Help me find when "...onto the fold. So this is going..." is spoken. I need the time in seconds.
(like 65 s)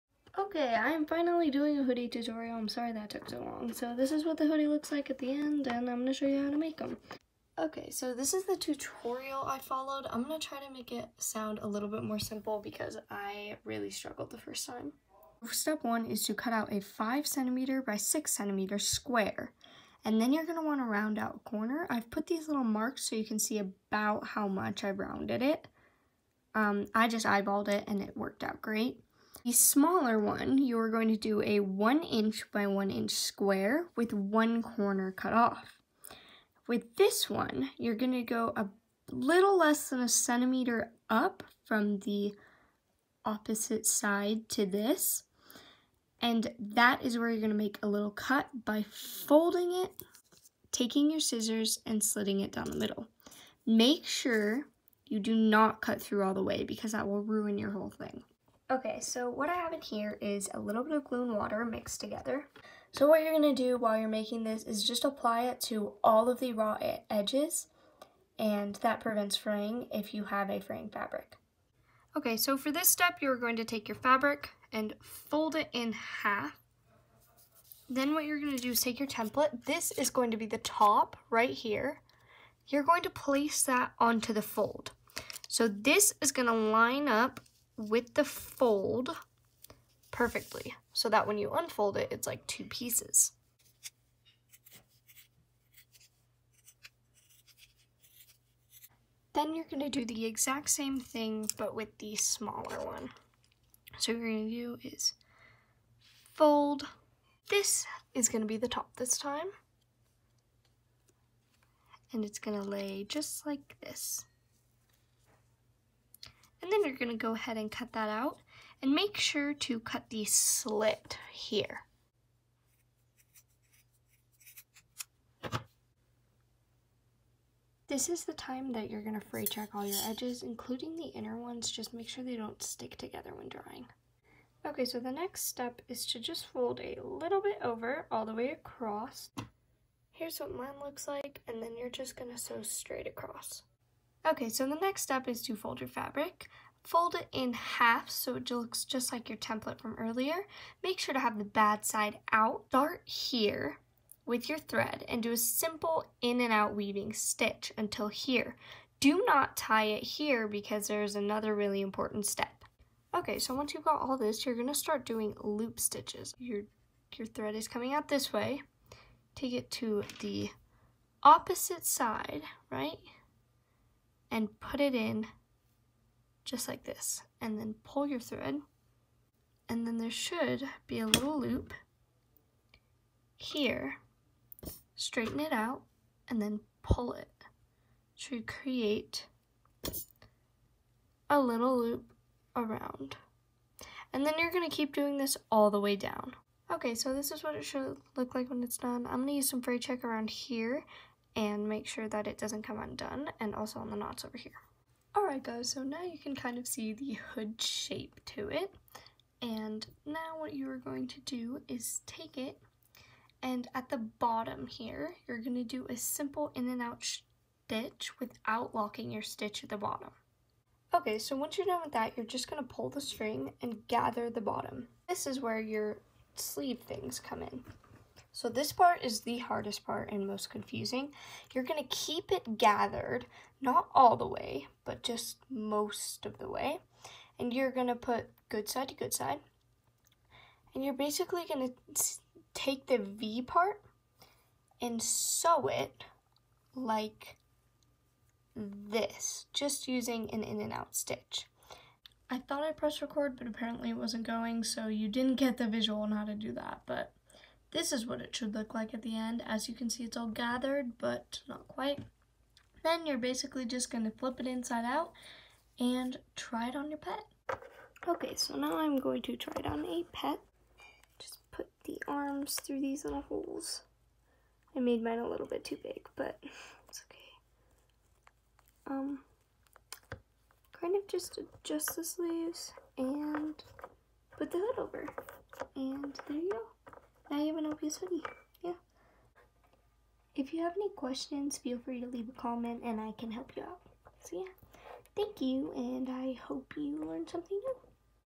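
83 s.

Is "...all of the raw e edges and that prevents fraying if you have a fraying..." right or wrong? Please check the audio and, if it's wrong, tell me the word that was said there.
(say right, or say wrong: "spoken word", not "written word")
right.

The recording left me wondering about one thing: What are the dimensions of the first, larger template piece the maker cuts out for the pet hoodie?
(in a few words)
5 cm by 6 cm.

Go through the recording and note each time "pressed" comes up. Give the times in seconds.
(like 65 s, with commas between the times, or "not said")
252 s.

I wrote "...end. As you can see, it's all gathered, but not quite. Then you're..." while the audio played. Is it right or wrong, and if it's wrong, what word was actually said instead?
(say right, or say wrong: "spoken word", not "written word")
right.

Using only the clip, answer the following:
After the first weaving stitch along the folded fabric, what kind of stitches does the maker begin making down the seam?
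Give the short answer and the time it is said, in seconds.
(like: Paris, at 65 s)
Loop stitches, at 165 s.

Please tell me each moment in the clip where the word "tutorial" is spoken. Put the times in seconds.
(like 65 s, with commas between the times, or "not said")
2 s, 8 s.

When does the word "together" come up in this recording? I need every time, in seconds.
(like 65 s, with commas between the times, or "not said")
61 s, 132 s.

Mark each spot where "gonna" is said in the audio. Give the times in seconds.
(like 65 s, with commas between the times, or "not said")
116 s, 164 s.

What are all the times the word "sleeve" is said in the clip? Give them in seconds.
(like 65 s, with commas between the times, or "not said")
226 s, 282 s.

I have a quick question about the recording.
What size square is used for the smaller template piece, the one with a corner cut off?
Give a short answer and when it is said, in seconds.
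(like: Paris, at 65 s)
1 inch by 1 inch, at 31 s.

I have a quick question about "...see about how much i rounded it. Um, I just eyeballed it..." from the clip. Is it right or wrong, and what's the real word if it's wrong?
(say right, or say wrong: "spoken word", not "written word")
right.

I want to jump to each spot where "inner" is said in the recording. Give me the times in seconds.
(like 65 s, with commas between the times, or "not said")
131 s.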